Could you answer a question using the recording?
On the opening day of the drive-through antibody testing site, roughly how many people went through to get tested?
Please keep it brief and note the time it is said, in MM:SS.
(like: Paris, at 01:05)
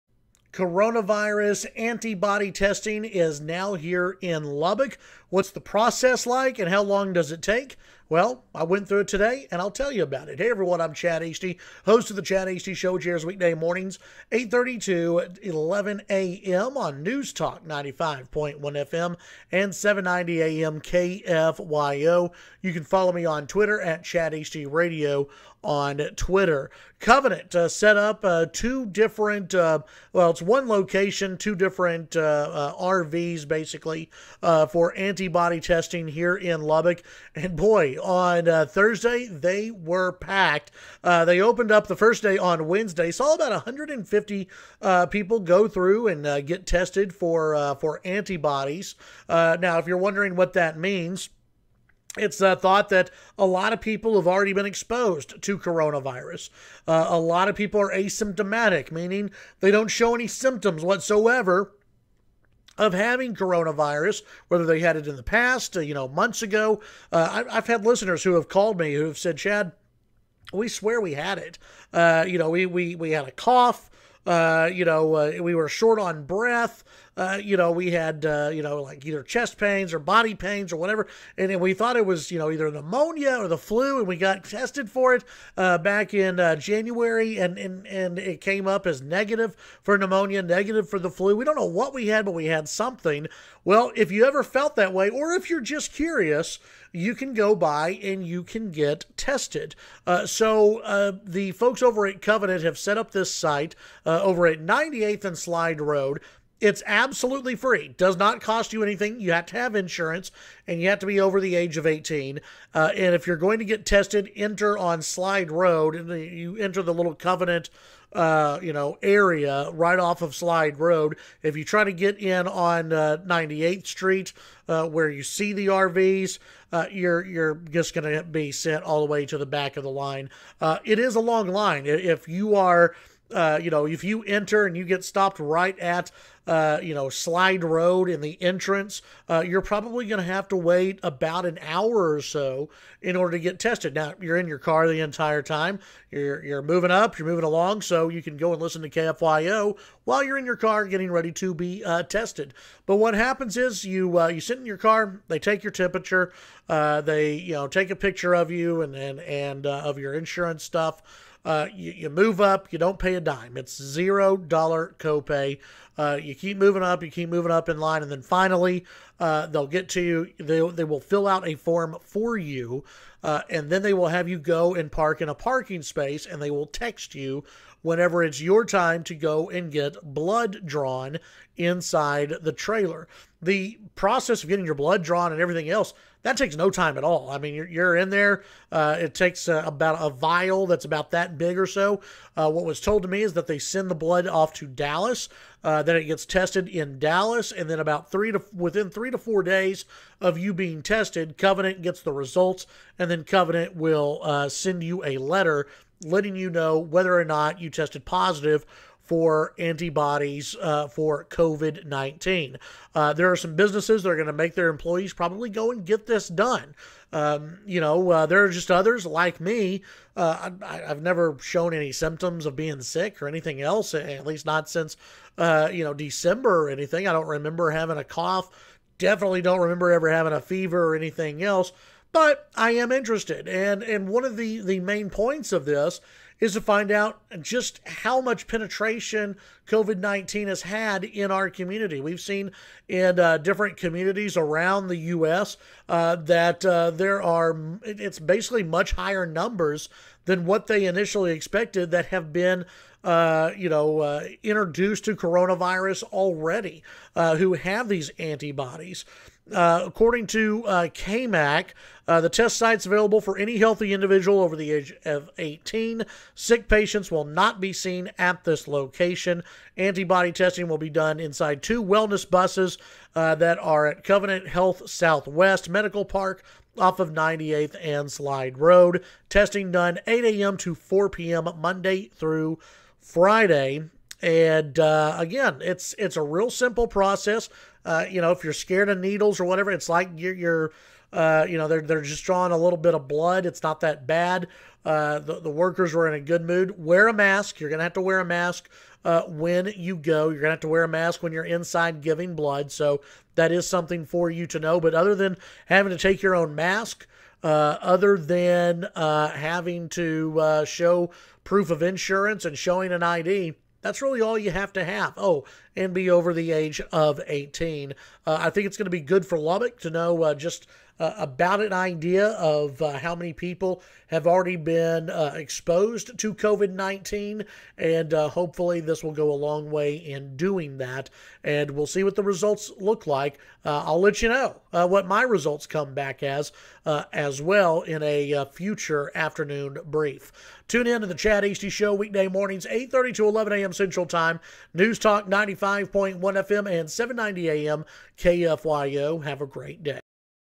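150, at 00:43.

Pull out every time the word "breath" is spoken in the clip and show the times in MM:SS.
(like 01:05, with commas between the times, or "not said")
01:16.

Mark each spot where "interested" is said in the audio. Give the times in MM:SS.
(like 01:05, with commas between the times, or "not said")
03:52.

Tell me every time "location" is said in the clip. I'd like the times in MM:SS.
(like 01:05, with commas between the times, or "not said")
00:30, 04:28.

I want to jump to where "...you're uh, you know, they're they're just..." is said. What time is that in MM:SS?
04:50.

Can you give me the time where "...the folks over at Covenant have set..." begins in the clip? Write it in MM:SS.
01:41.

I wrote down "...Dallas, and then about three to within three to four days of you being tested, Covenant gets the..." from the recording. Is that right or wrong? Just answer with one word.
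right.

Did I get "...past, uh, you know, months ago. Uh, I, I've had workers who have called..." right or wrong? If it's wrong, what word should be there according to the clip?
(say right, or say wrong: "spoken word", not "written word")
wrong: "listeners", not "workers".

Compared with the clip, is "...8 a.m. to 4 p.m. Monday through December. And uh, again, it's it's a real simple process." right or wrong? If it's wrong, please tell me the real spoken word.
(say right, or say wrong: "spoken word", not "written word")
wrong: "Friday", not "December".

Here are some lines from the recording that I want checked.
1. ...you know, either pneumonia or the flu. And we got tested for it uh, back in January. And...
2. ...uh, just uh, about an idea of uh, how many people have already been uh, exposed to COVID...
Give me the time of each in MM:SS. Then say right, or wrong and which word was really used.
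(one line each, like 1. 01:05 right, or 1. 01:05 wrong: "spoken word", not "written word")
1. 01:22 right
2. 05:20 right.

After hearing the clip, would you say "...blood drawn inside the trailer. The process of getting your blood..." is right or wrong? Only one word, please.
right.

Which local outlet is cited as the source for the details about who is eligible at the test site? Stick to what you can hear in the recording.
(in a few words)
KAMC.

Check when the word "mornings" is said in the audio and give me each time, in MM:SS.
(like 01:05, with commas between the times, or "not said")
00:13, 05:42.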